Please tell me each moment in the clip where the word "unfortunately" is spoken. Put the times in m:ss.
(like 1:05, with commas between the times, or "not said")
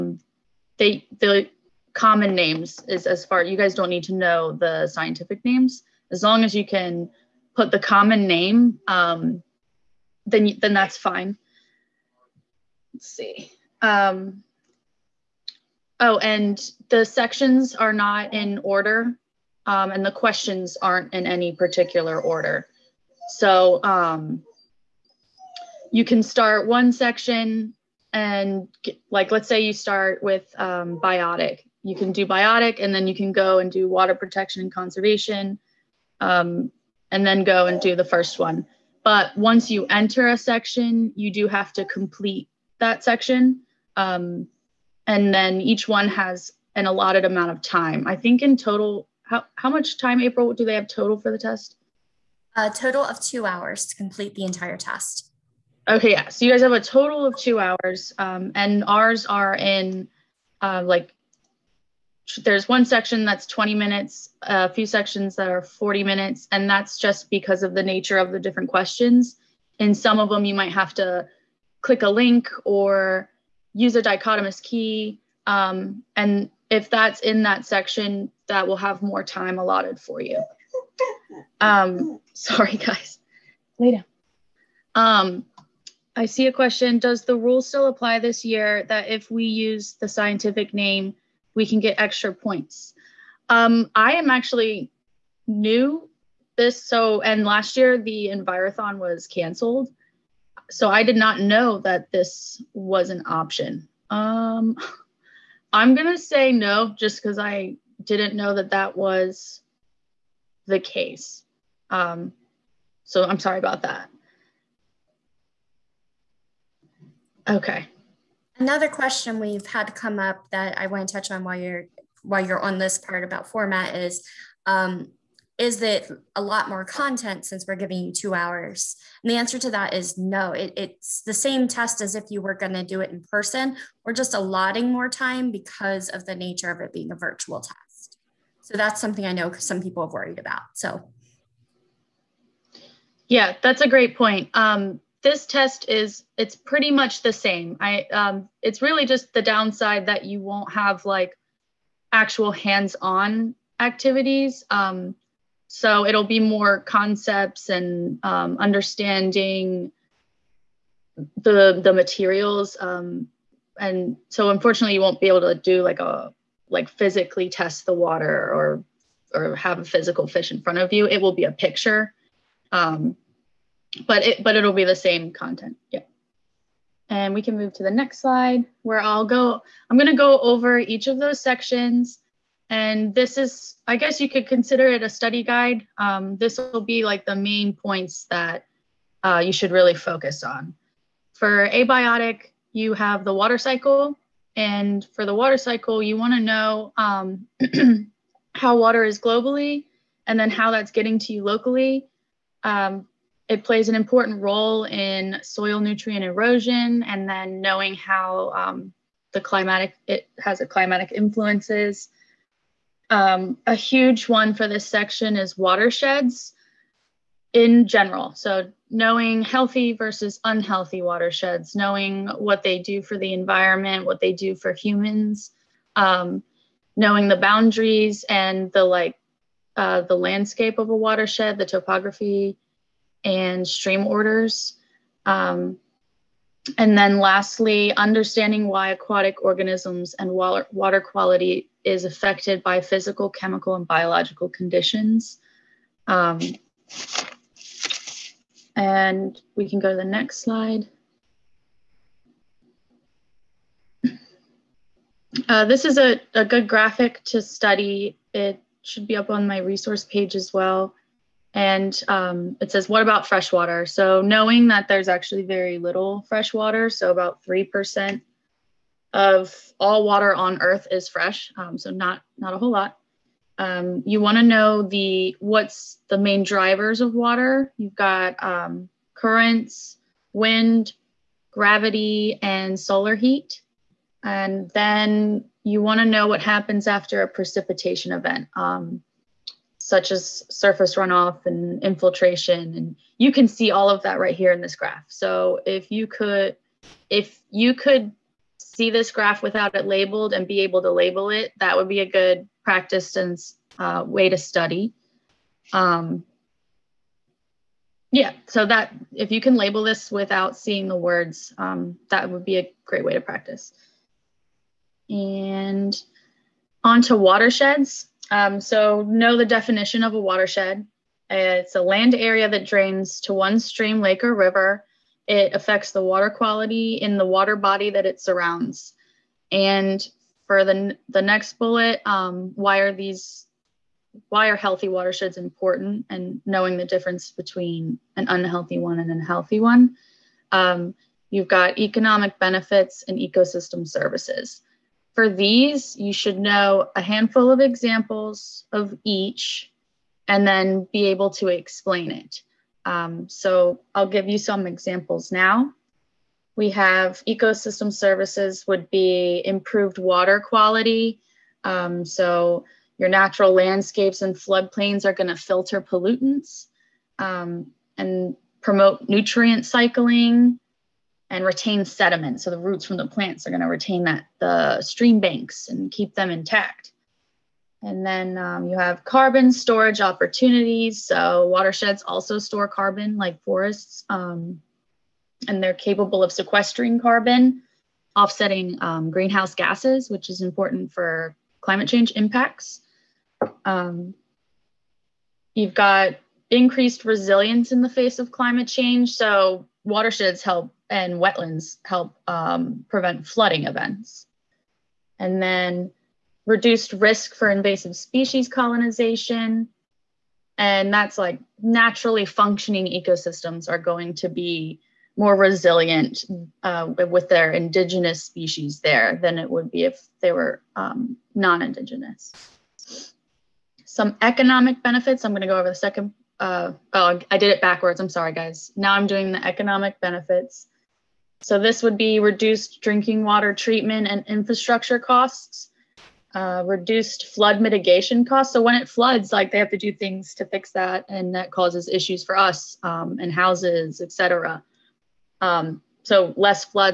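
2:44.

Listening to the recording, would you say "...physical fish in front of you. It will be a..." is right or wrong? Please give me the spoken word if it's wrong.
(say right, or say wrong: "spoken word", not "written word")
right.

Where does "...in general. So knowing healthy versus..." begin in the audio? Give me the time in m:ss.
3:37.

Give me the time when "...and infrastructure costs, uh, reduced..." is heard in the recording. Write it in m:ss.
7:14.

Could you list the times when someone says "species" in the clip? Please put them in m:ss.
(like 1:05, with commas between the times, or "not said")
6:47, 6:58.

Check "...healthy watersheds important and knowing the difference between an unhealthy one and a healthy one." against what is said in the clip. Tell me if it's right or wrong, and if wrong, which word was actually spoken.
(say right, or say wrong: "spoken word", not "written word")
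right.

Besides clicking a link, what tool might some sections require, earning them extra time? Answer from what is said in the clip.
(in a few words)
dichotomous key.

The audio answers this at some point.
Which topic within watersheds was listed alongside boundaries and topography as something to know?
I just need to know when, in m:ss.
3:53.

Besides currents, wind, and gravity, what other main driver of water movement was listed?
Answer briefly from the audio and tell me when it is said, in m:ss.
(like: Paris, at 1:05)
solar heat, at 4:42.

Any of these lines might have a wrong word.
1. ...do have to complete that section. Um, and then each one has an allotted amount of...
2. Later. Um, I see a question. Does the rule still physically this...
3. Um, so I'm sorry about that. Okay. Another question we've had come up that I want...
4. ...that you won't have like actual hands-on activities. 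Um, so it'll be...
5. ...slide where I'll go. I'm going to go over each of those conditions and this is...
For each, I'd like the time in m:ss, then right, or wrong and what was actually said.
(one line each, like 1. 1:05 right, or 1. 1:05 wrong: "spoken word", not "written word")
1. 0:41 right
2. 1:23 wrong: "apply", not "physically"
3. 1:51 right
4. 2:30 right
5. 2:58 wrong: "sections", not "conditions".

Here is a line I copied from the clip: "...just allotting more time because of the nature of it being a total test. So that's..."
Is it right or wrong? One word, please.
wrong.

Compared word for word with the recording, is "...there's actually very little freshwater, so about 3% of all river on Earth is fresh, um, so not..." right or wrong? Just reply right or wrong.
wrong.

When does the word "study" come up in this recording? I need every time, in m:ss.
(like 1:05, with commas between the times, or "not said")
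3:05, 4:17, 5:04.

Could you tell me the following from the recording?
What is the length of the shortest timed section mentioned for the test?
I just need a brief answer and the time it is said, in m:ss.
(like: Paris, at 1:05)
20 minutes, at 1:03.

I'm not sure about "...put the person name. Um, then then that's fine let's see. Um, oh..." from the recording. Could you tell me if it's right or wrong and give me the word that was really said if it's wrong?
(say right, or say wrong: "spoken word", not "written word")
wrong: "common", not "person".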